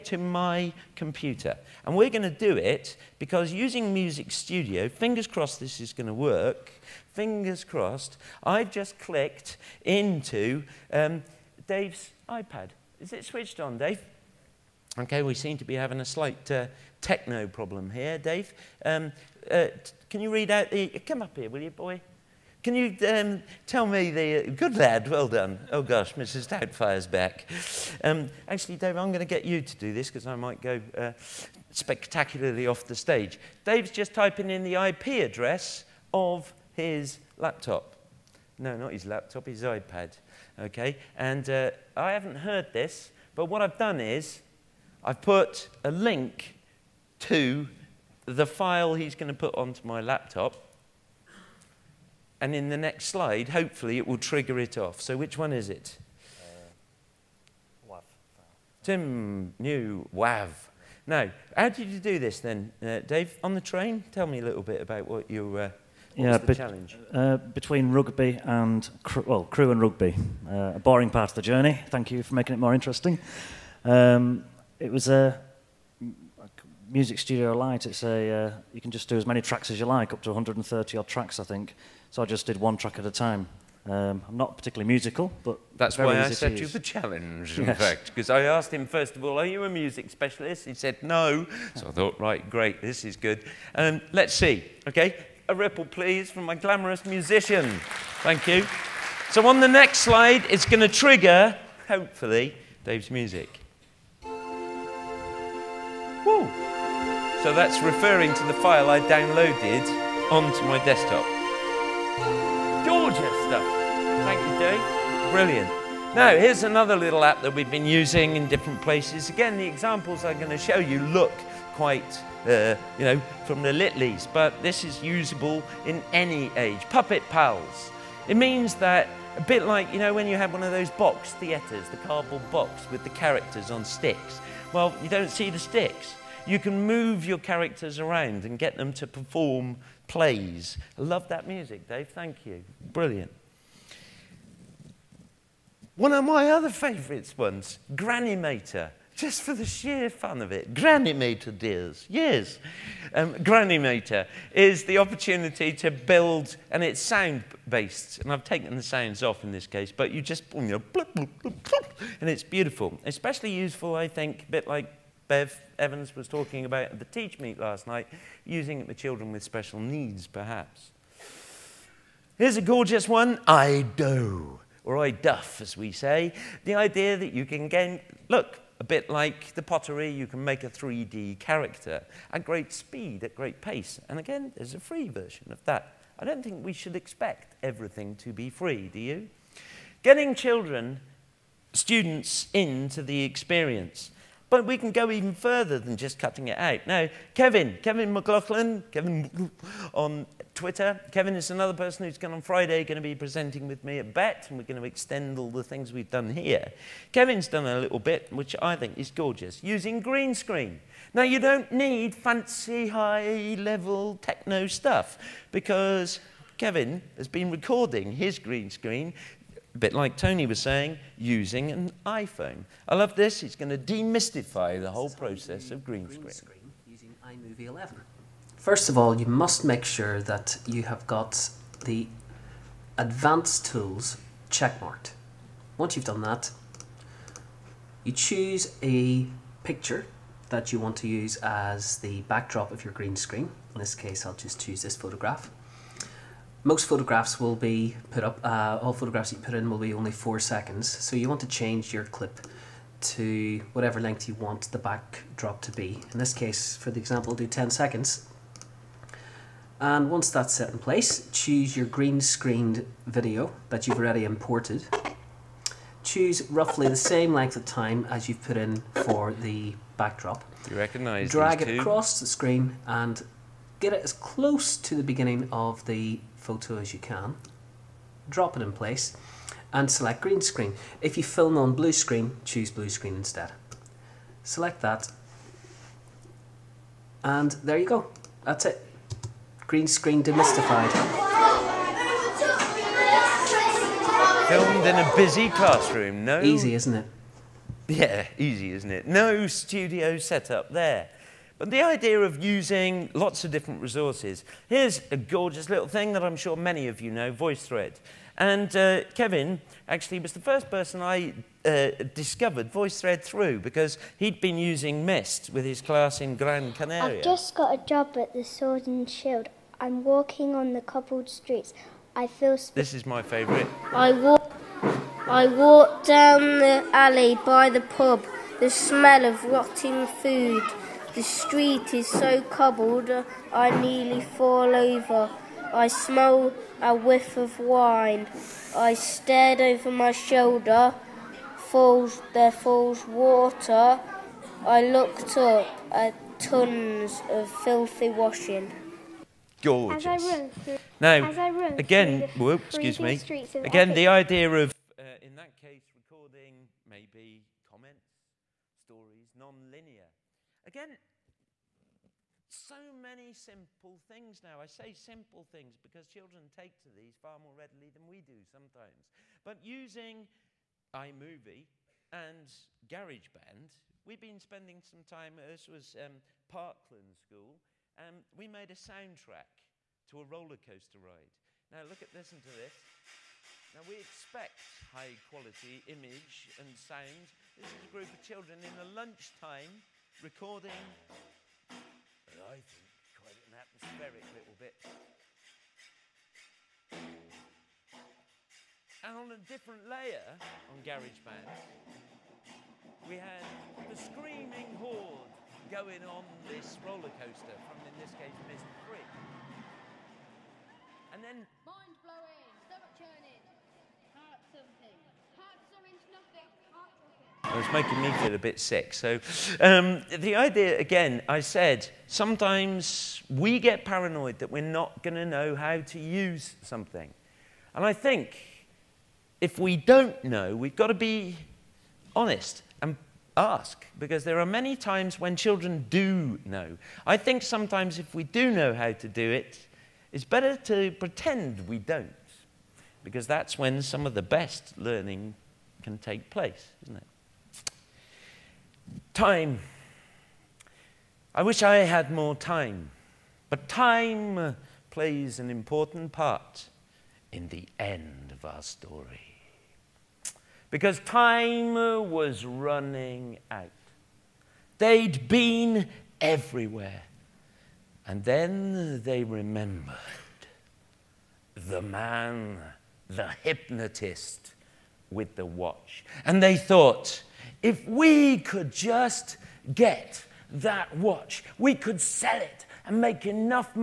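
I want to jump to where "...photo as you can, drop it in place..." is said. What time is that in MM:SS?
04:36.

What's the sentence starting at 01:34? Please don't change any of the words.
Okay, a ripple, please, from my glamorous musician.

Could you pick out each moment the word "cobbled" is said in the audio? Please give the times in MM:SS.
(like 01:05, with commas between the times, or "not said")
05:20, 05:32.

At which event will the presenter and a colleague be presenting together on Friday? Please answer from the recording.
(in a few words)
BETT.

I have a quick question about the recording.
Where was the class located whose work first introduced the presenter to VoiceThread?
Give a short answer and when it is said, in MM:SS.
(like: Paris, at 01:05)
Gran Canaria, at 05:16.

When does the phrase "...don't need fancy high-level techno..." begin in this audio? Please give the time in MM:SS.
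03:31.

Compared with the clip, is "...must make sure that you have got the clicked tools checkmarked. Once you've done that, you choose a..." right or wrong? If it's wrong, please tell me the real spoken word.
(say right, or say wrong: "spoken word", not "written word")
wrong: "advanced", not "clicked".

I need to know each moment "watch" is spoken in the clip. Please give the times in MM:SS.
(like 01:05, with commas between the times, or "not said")
07:55, 08:00.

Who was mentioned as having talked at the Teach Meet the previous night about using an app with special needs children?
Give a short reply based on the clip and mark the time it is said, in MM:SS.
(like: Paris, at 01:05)
Bev Evans, at 02:45.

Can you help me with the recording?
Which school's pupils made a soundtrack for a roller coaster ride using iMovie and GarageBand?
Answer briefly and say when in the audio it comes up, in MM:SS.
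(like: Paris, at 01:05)
Parkland School, at 06:16.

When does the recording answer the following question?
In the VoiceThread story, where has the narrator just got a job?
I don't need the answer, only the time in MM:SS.
05:18.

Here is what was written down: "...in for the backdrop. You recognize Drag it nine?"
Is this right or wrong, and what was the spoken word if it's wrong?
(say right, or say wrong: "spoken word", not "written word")
wrong: "two", not "nine".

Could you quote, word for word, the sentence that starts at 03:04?
And again, there's a free version of that.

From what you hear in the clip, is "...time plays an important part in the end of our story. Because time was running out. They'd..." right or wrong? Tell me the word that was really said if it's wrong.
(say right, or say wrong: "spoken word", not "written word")
right.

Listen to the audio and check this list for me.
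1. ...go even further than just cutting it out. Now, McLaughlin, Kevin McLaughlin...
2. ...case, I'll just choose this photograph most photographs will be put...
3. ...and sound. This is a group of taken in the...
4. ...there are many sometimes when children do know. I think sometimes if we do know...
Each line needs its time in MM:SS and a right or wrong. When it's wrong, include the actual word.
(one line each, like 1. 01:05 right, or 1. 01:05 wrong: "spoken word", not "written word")
1. 03:14 wrong: "Kevin", not "McLaughlin"
2. 04:03 right
3. 06:26 wrong: "children", not "taken"
4. 07:14 wrong: "times", not "sometimes".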